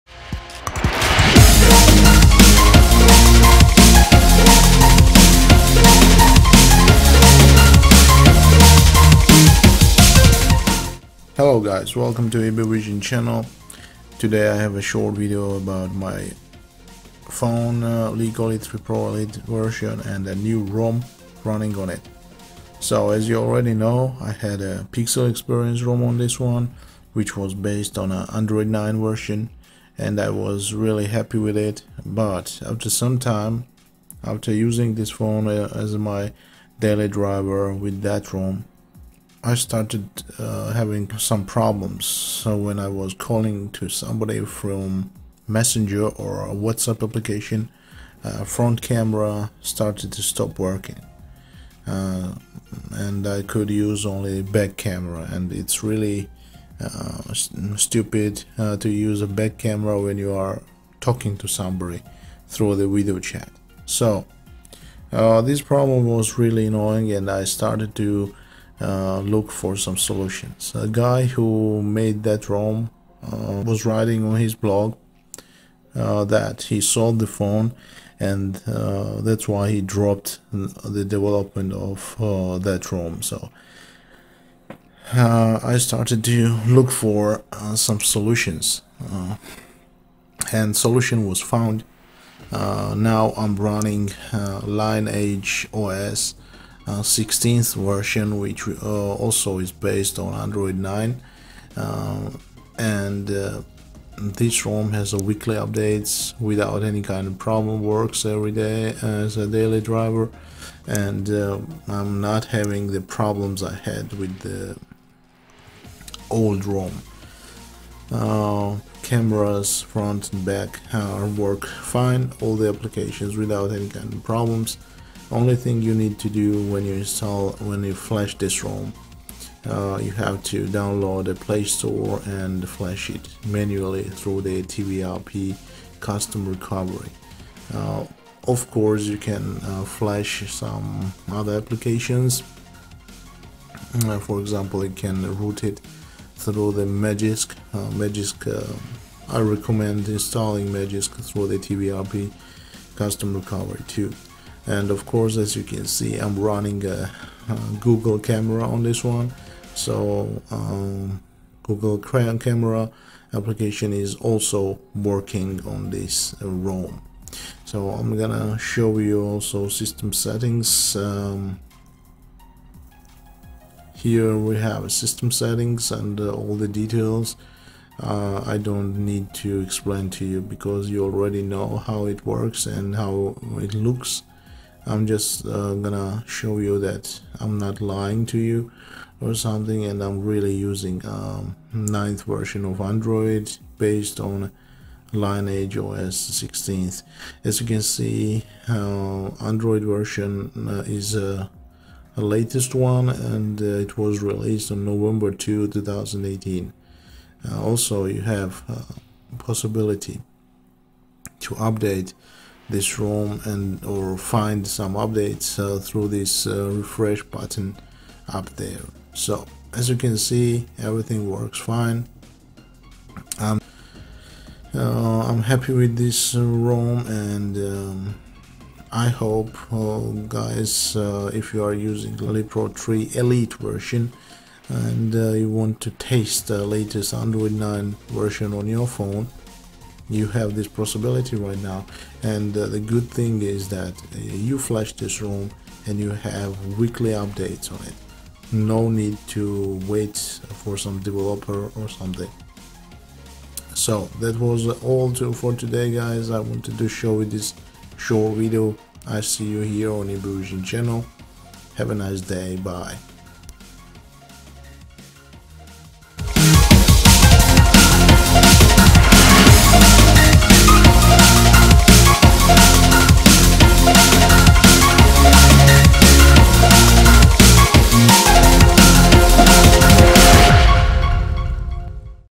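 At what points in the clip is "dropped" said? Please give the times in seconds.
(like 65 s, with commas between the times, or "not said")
79 s.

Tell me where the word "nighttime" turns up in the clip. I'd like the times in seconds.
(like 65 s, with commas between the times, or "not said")
not said.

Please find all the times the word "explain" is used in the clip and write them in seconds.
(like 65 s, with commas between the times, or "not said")
179 s.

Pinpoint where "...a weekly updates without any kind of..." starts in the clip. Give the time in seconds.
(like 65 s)
105 s.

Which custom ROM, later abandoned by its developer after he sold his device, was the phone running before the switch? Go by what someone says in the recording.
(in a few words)
Pixel Experience.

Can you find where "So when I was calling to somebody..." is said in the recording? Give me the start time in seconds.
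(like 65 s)
42 s.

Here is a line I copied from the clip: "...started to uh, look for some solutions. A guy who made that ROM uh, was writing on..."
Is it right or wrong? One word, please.
right.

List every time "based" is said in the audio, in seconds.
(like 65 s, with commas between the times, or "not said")
27 s, 99 s, 193 s.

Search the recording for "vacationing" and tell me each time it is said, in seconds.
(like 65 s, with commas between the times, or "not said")
not said.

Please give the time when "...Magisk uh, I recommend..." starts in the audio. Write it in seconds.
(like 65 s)
147 s.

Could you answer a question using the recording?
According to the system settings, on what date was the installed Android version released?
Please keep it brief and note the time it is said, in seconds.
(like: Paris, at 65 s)
November 2, 2018, at 204 s.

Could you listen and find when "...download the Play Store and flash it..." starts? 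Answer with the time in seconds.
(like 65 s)
130 s.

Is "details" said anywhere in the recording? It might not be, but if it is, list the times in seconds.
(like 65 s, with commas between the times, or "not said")
176 s.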